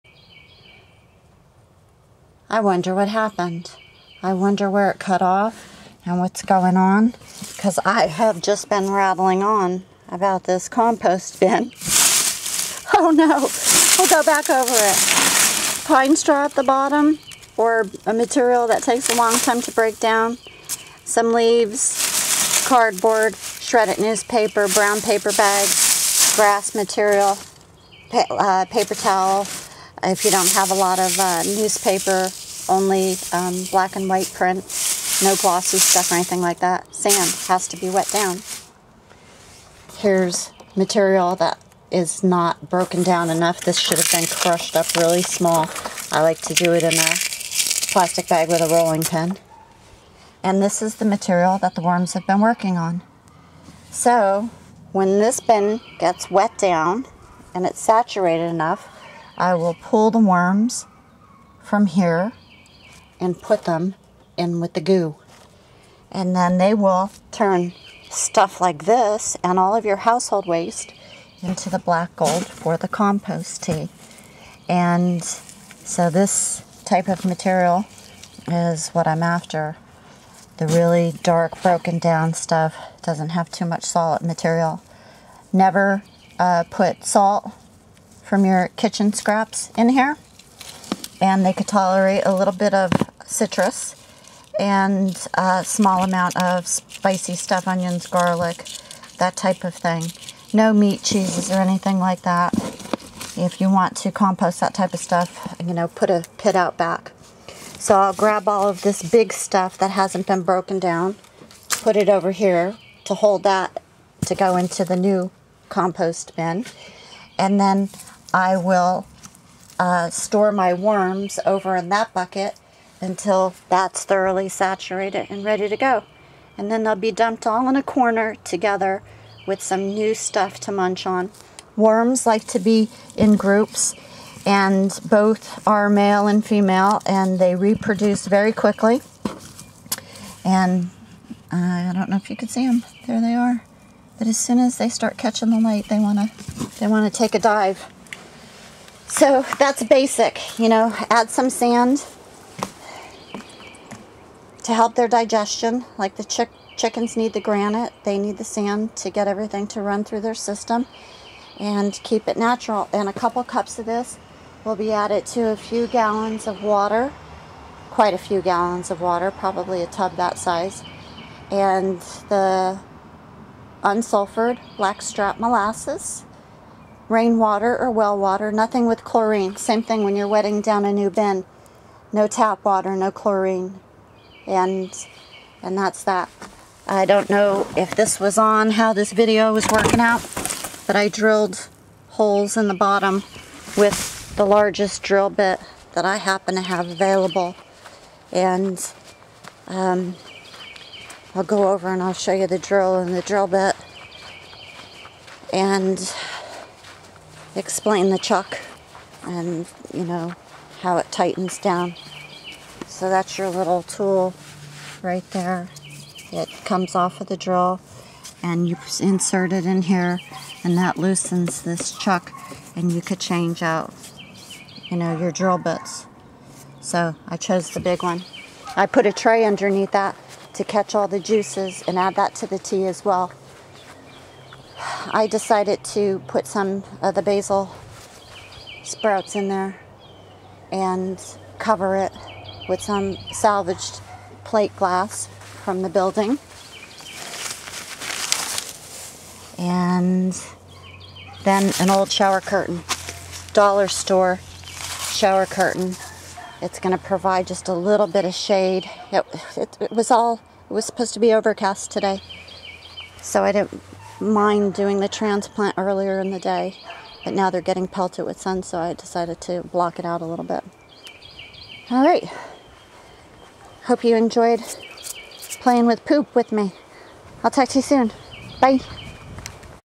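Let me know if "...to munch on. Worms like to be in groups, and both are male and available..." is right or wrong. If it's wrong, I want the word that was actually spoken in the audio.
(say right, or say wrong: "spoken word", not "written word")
wrong: "female", not "available".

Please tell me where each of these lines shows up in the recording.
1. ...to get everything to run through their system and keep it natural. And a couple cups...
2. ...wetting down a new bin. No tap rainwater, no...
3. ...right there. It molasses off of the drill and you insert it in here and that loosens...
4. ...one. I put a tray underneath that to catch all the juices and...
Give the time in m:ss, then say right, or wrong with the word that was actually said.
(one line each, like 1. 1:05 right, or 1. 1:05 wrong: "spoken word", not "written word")
1. 2:38 right
2. 3:00 wrong: "water", not "rainwater"
3. 3:35 wrong: "comes", not "molasses"
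4. 3:48 right.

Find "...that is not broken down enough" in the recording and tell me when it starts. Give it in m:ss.
0:41.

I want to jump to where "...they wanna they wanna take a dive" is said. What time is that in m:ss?
2:25.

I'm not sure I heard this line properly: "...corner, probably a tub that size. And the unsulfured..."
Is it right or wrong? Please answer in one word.
wrong.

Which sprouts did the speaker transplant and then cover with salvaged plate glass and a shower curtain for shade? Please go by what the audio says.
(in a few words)
Basil.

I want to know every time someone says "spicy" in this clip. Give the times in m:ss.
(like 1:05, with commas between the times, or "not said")
1:36.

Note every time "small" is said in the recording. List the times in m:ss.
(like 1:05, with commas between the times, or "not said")
0:45, 1:35.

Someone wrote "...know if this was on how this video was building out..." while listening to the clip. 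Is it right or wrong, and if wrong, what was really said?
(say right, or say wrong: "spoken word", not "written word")
wrong: "working", not "building".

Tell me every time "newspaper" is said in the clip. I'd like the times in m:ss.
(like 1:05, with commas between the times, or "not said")
0:23, 0:31.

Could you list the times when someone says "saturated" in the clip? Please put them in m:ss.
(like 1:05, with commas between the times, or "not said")
0:57, 2:04.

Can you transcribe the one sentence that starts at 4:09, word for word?
And then an old shower curtain, dollar store shower curtain.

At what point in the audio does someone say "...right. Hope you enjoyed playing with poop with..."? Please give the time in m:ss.
4:32.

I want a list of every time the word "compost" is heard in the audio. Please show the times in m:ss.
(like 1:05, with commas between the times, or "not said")
0:10, 1:12, 1:44, 1:55.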